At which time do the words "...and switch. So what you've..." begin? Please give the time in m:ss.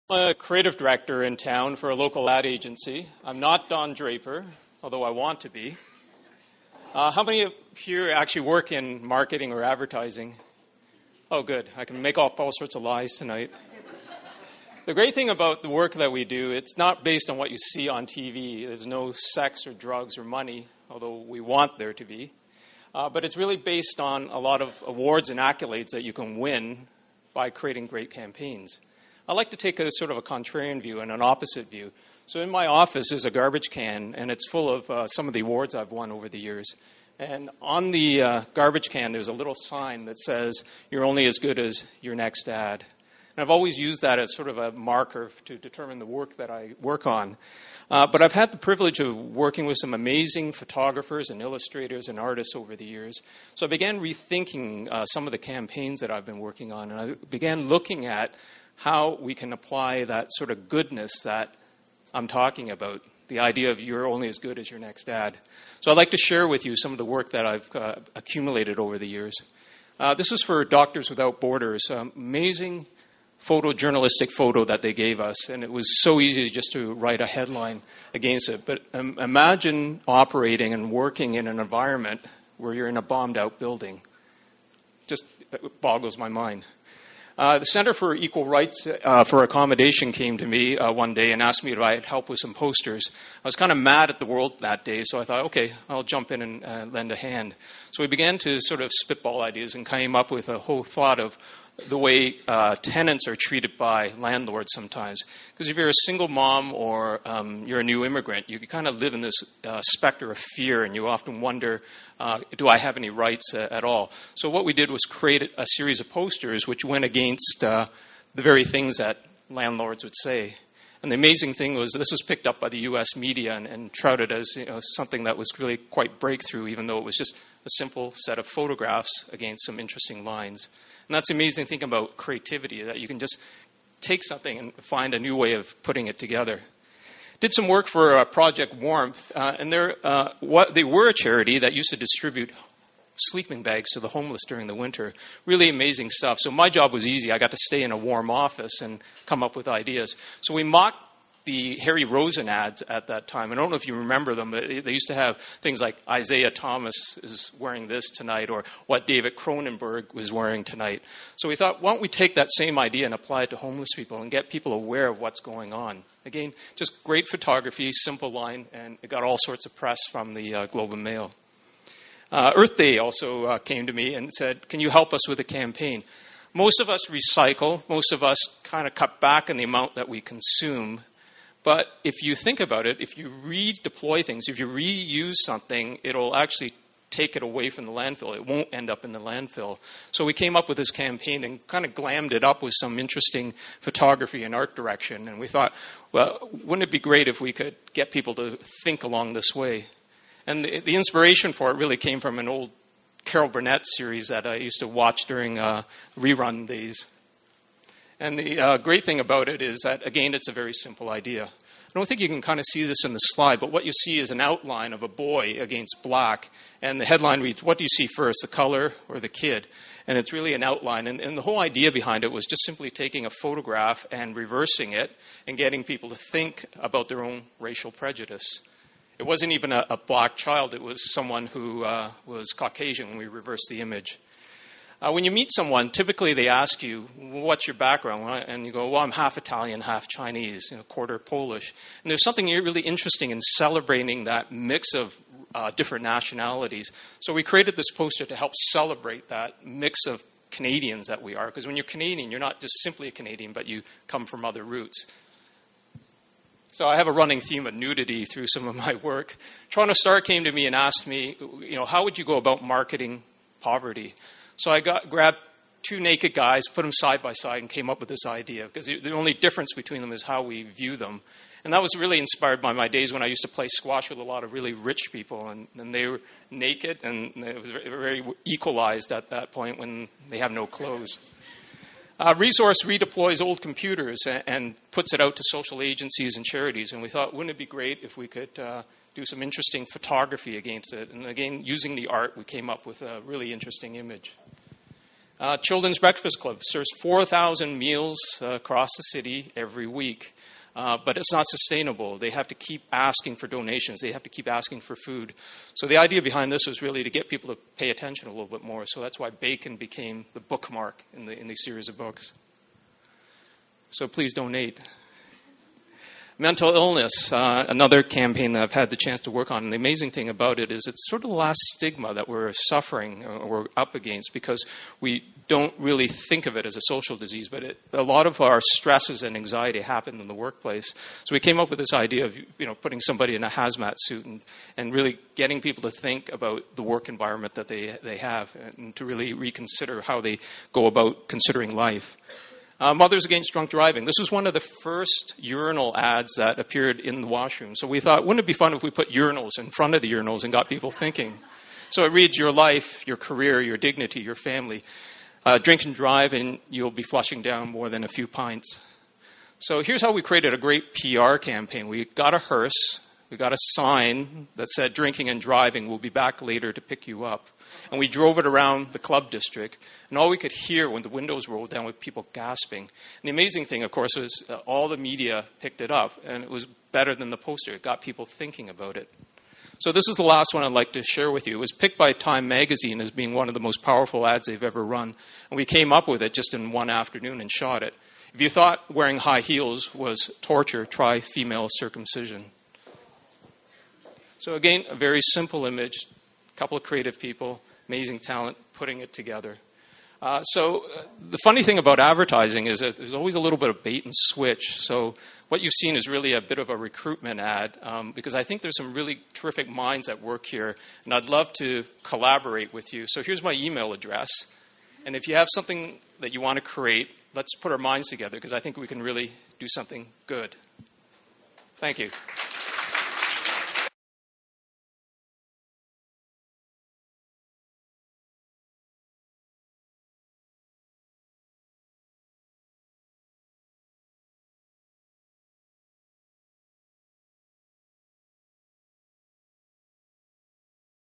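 6:44.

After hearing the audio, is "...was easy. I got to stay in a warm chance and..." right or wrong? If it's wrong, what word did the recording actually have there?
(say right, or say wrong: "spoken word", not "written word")
wrong: "office", not "chance".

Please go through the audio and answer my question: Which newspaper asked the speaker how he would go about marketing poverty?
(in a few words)
Toronto Star.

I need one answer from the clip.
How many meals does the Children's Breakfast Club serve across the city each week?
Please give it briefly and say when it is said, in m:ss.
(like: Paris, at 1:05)
4,000, at 4:57.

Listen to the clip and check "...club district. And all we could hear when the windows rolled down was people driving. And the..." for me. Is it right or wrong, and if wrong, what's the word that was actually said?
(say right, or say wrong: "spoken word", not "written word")
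wrong: "gasping", not "driving".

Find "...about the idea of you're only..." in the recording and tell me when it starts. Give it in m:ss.
1:02.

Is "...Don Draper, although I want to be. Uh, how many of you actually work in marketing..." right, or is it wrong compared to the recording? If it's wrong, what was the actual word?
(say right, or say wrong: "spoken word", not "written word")
right.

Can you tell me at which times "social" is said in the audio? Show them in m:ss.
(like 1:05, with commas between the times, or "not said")
4:45, 5:26.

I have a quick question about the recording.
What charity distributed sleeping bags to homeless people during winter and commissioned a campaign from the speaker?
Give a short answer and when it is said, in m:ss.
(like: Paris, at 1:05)
Project Warmth, at 2:18.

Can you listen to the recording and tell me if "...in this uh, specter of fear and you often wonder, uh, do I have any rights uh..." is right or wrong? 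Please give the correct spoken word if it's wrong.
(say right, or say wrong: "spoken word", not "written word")
right.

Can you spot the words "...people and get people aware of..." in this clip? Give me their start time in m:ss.
2:43.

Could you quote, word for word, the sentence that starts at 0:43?
And I've always used that as sort of a marker to determine the work that I work on.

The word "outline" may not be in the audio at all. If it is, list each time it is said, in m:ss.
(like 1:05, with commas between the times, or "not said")
3:34, 3:40.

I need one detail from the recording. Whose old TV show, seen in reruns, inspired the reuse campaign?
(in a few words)
Carol Burnett.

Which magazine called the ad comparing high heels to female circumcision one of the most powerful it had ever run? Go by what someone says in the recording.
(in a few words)
Time Magazine.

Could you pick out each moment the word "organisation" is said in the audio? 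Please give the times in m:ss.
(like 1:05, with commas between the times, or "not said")
not said.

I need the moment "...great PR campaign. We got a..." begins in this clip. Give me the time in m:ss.
6:00.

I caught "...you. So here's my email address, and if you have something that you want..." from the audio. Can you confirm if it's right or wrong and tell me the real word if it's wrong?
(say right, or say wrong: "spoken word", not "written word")
right.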